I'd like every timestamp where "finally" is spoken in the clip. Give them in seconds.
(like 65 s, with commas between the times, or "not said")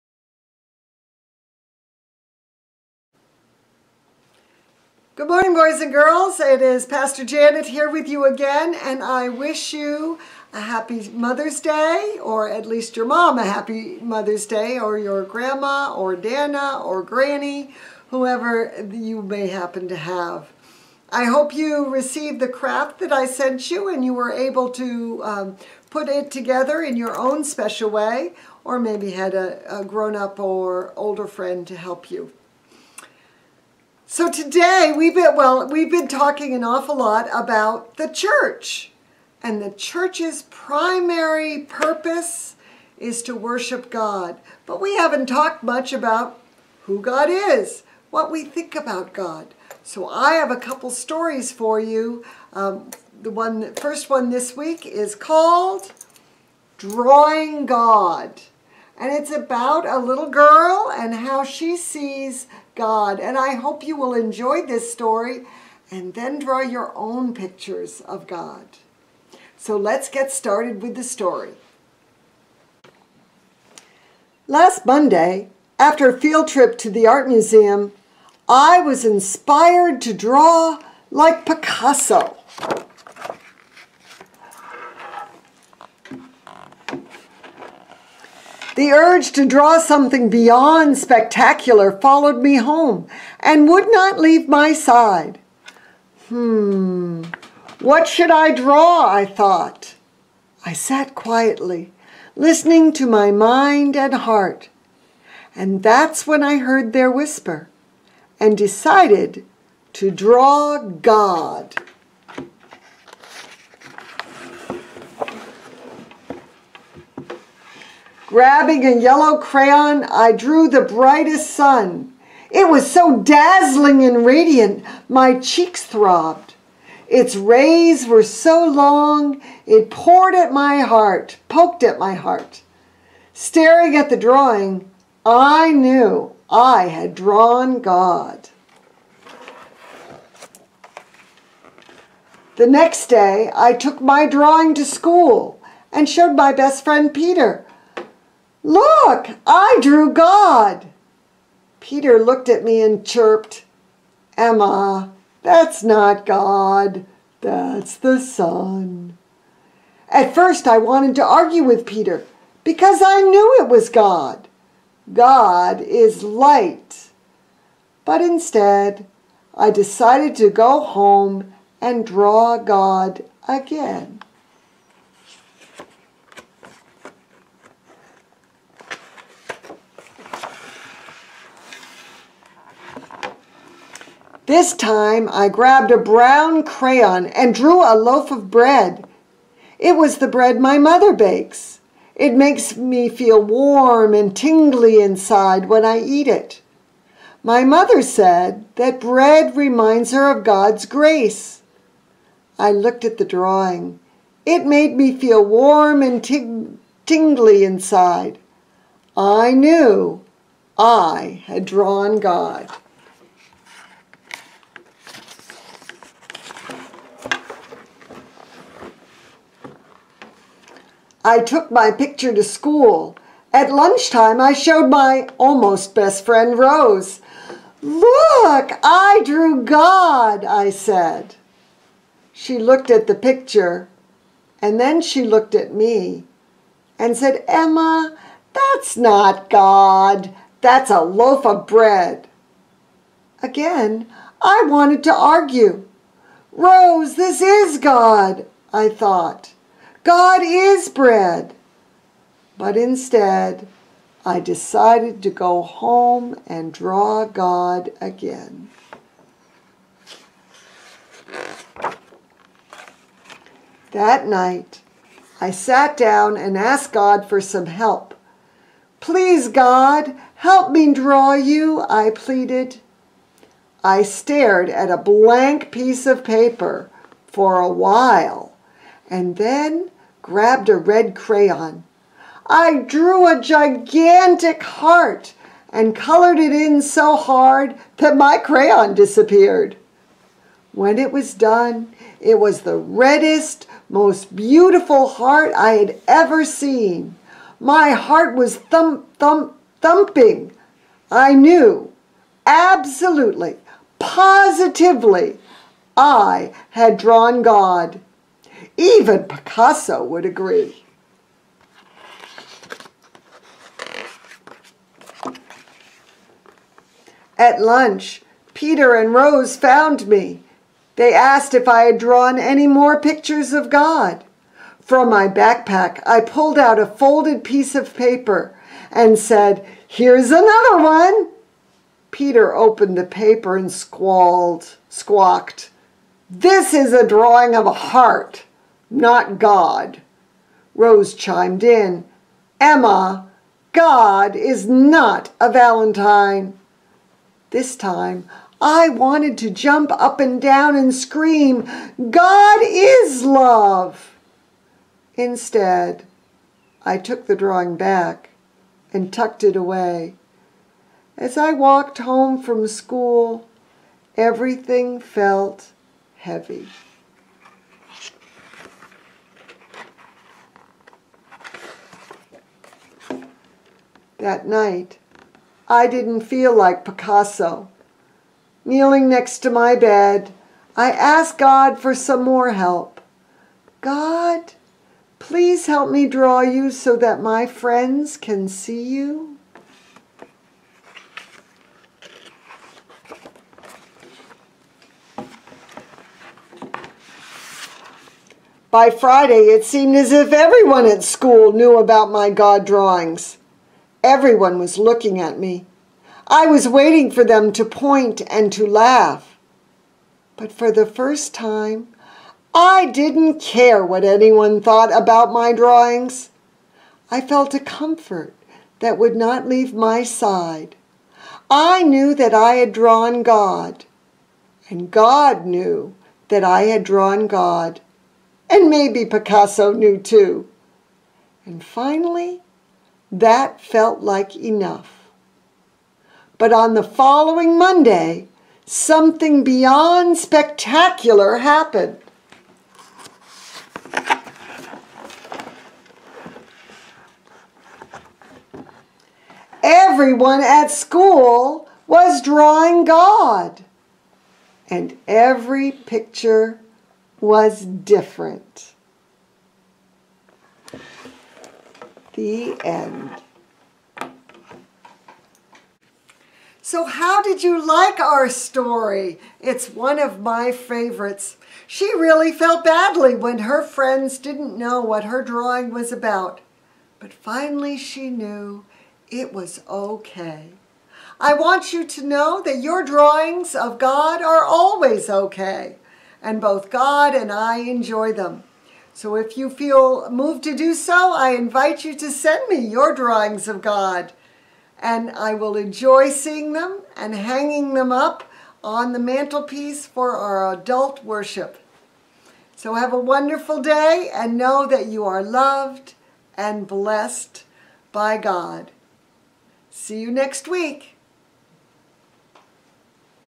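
431 s, 477 s.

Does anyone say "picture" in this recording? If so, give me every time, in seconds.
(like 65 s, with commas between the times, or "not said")
67 s, 221 s, 233 s, 322 s, 455 s.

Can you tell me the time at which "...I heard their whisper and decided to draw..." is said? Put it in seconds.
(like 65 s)
106 s.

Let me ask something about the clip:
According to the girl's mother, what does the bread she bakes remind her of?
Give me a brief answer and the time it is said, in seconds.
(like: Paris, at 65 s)
God's grace, at 200 s.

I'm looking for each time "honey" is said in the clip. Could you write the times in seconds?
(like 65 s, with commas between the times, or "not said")
not said.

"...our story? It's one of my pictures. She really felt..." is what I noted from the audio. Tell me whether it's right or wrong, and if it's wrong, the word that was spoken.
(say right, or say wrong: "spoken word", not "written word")
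wrong: "favorites", not "pictures".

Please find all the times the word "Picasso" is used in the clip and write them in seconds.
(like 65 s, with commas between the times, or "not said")
81 s, 309 s, 376 s, 429 s.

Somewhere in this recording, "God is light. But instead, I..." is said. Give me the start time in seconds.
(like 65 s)
165 s.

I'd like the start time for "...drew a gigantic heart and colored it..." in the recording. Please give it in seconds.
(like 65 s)
282 s.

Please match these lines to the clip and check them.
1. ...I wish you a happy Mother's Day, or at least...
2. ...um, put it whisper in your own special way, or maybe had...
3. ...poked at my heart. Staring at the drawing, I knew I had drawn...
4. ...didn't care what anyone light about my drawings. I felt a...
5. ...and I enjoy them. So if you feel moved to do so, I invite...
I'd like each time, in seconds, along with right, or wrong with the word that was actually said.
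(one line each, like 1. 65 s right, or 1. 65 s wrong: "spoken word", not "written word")
1. 9 s right
2. 25 s wrong: "together", not "whisper"
3. 131 s right
4. 412 s wrong: "thought", not "light"
5. 487 s right.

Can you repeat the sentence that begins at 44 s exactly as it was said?
But we haven't talked much about who God is, what we think about God.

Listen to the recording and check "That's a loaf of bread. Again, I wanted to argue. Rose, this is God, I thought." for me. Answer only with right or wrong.
right.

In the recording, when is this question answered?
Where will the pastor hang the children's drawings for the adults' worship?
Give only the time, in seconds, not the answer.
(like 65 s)
498 s.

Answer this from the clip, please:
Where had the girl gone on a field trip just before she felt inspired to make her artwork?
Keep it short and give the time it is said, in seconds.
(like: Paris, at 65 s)
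The art museum, at 77 s.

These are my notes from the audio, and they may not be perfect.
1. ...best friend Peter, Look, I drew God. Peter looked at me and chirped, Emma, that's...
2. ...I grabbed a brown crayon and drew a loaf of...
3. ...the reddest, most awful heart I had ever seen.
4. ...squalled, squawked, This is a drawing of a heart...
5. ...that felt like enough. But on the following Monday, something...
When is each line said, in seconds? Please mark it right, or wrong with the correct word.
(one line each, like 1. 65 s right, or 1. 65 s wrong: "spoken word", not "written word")
1. 146 s right
2. 185 s right
3. 292 s wrong: "beautiful", not "awful"
4. 333 s right
5. 433 s right.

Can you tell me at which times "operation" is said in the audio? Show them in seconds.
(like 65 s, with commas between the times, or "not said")
not said.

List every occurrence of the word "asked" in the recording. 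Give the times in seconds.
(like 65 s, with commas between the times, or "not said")
266 s, 321 s, 380 s.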